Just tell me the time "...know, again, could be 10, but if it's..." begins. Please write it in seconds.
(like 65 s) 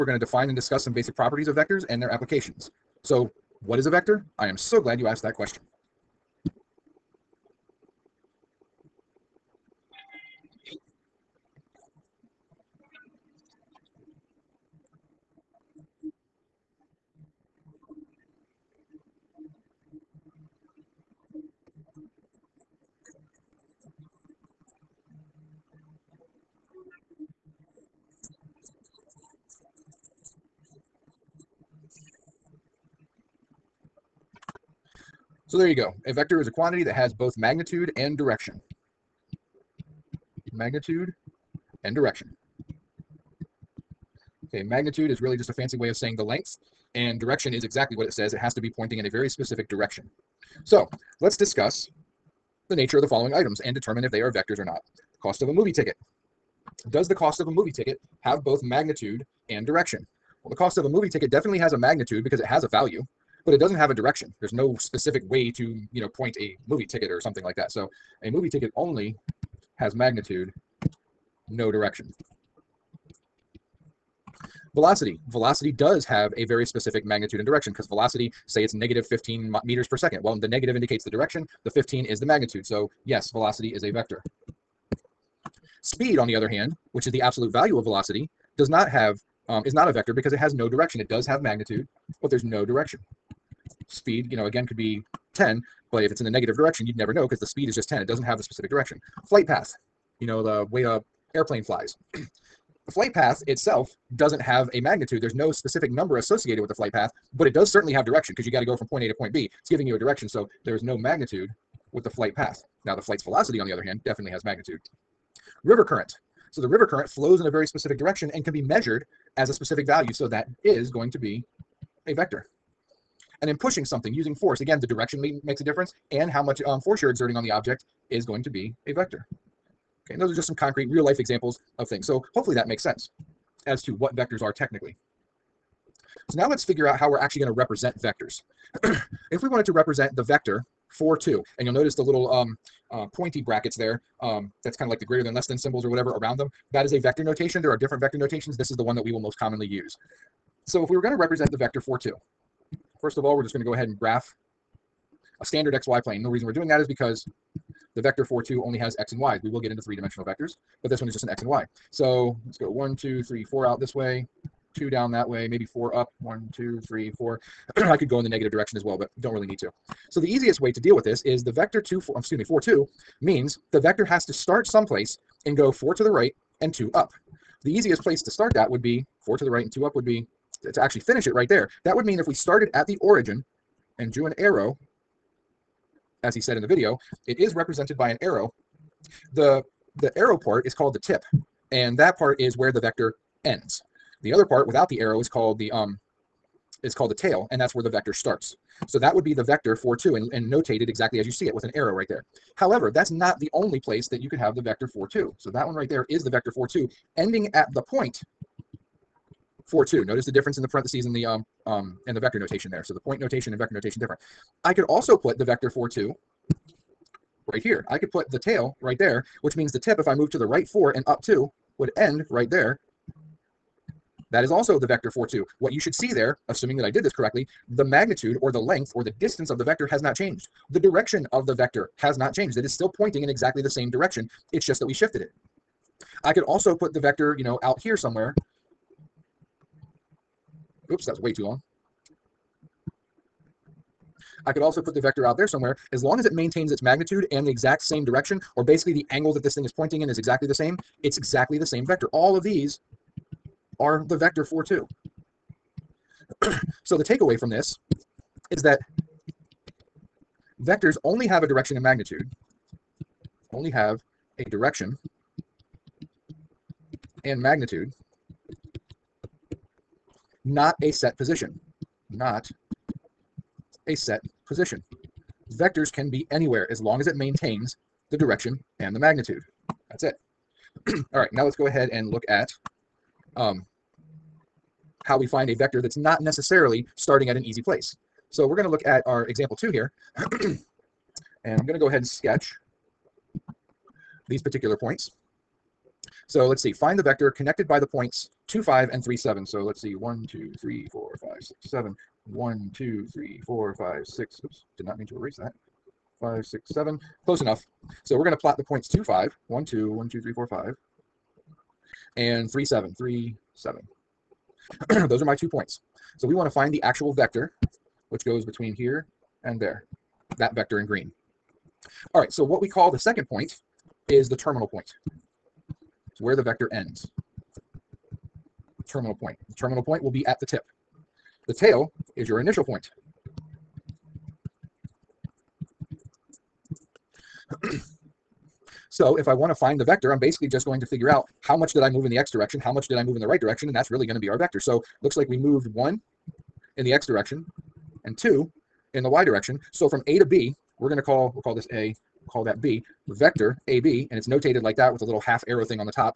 94 s.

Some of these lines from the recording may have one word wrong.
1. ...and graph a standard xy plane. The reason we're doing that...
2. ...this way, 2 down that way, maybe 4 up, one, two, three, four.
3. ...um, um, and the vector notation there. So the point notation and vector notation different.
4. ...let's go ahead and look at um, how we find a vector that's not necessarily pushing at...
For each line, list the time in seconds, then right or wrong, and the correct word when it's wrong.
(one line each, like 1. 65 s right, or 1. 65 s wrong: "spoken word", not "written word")
1. 153 s right
2. 163 s right
3. 211 s right
4. 281 s wrong: "starting", not "pushing".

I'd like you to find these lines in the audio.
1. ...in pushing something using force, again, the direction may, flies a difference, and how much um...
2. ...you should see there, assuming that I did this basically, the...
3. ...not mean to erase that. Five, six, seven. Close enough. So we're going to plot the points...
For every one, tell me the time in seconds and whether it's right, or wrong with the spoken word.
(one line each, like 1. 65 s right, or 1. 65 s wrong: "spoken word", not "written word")
1. 123 s wrong: "makes", not "flies"
2. 225 s wrong: "correctly", not "basically"
3. 304 s right.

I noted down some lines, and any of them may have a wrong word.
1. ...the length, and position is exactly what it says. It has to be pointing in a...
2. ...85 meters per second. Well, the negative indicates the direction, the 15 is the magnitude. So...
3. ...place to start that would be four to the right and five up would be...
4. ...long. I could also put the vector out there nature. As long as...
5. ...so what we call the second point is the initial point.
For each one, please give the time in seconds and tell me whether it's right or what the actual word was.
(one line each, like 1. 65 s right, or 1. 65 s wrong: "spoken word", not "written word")
1. 46 s wrong: "direction", not "position"
2. 79 s wrong: "15", not "85"
3. 177 s wrong: "two", not "five"
4. 241 s wrong: "somewhere", not "nature"
5. 322 s wrong: "terminal", not "initial".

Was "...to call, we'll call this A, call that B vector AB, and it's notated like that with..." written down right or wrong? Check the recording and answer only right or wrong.
right.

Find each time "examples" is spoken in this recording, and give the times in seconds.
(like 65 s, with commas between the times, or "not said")
131 s, 289 s.